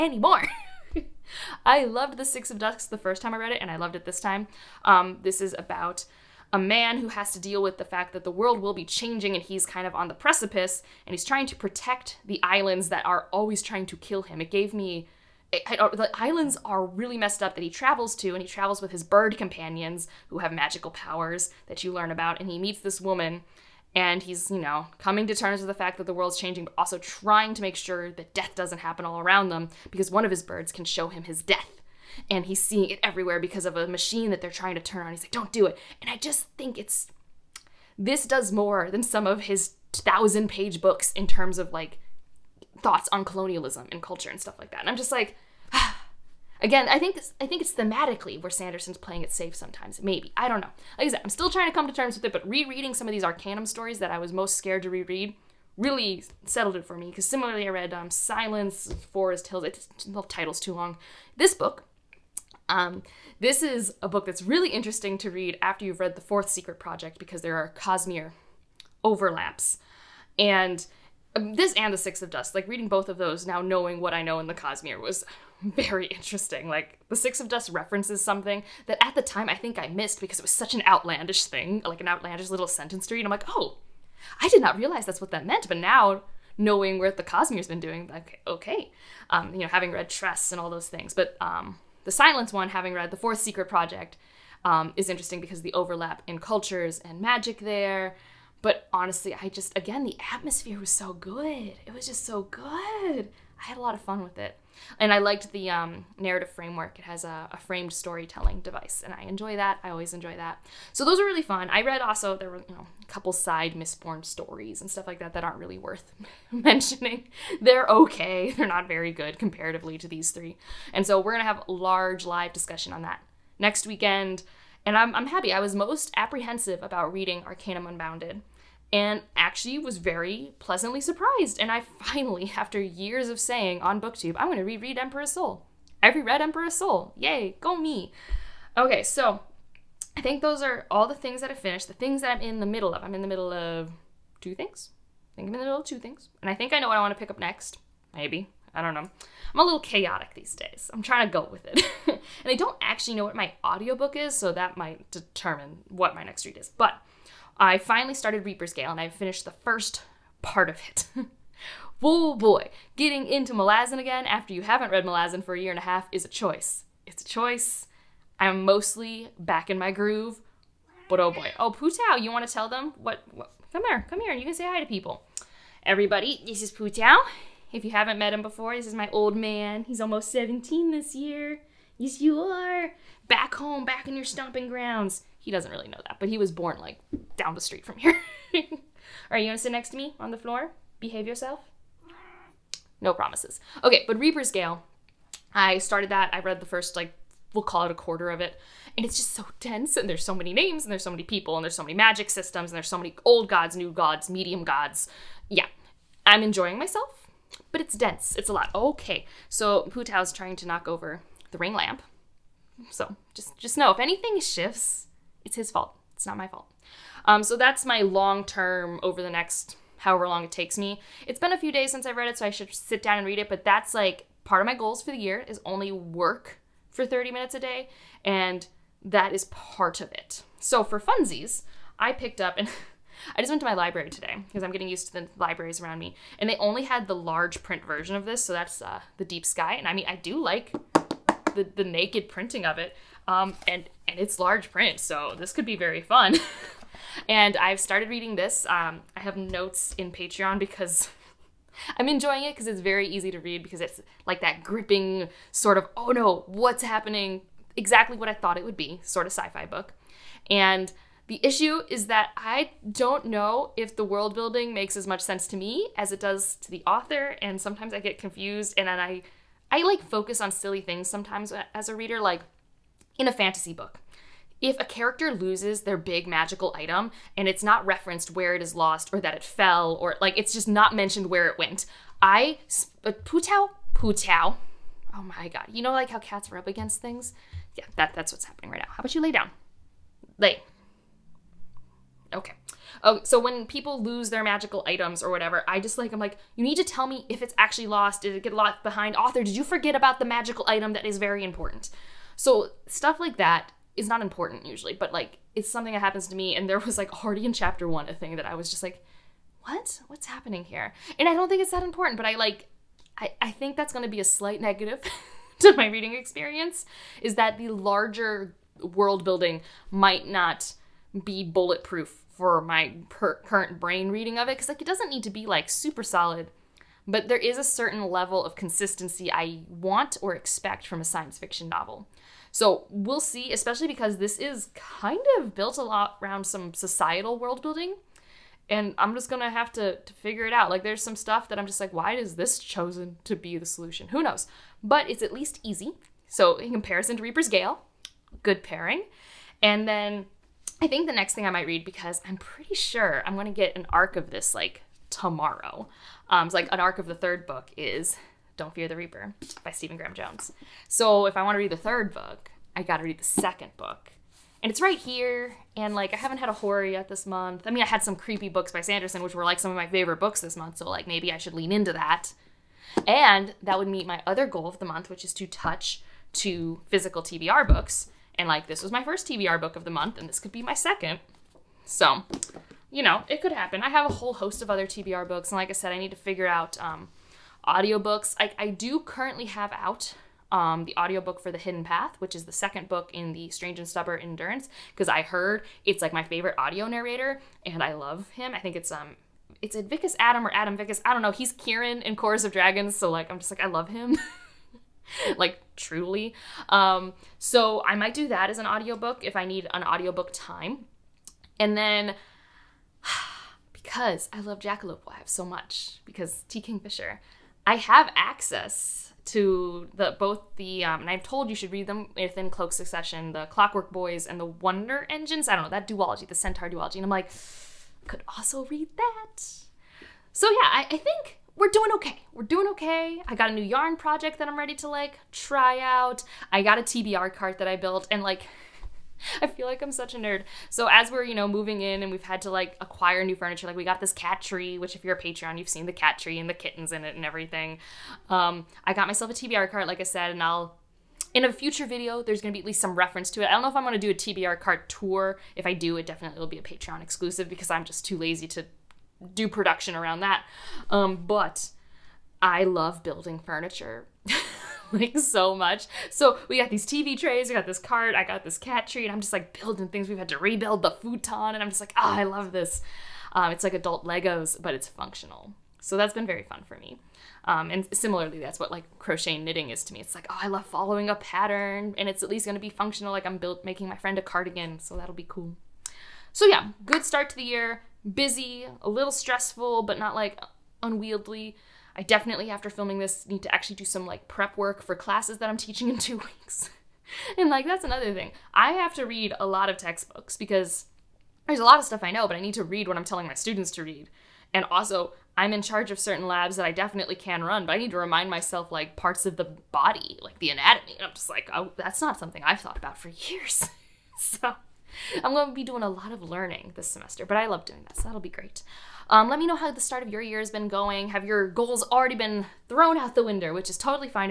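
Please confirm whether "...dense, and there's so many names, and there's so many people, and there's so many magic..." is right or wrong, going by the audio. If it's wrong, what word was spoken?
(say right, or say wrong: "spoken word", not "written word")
right.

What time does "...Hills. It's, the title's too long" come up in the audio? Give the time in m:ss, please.
0:59.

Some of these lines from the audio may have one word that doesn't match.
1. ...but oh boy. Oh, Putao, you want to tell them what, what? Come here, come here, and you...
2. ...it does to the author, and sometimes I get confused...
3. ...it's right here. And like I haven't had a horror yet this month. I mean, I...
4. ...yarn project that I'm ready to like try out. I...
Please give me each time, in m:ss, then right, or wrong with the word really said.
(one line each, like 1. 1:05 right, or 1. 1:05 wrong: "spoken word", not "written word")
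1. 2:51 right
2. 4:26 right
3. 6:04 right
4. 7:13 right.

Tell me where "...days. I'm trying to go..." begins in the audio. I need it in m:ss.
2:30.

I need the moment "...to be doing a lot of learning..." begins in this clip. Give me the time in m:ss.
8:35.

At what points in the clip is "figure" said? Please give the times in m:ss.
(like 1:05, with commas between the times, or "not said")
5:40, 6:26.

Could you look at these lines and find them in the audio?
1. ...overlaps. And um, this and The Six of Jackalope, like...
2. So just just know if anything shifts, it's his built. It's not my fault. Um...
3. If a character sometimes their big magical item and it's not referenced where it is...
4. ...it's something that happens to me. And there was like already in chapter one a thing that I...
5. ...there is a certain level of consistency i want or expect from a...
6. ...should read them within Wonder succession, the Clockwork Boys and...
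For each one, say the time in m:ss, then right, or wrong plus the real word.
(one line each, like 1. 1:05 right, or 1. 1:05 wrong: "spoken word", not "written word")
1. 1:09 wrong: "Dusk", not "Jackalope"
2. 3:32 wrong: "fault", not "built"
3. 4:34 wrong: "loses", not "sometimes"
4. 5:05 right
5. 5:27 right
6. 7:01 wrong: "Cloak", not "Wonder".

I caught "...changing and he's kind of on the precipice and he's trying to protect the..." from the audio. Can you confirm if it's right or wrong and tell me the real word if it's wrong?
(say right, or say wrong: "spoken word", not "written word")
right.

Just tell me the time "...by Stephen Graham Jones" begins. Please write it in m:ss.
5:59.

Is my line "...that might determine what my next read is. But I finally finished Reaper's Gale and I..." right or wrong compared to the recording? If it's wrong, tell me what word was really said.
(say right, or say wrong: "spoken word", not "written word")
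wrong: "started", not "finished".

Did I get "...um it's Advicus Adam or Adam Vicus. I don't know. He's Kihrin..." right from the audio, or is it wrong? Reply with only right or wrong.
right.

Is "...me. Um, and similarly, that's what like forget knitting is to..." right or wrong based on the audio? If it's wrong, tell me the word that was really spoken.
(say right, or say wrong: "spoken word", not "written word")
wrong: "crochet", not "forget".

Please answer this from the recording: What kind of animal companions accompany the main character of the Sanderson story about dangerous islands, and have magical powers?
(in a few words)
Birds.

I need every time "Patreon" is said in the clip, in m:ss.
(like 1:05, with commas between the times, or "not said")
4:10, 7:25, 7:36.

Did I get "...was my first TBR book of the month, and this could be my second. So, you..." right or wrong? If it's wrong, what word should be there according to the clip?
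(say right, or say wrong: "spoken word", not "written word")
right.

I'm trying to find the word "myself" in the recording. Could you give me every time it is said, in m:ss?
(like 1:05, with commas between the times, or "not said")
3:26, 7:29, 8:28.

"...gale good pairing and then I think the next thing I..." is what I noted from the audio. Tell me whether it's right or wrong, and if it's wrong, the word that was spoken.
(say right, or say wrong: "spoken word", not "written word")
right.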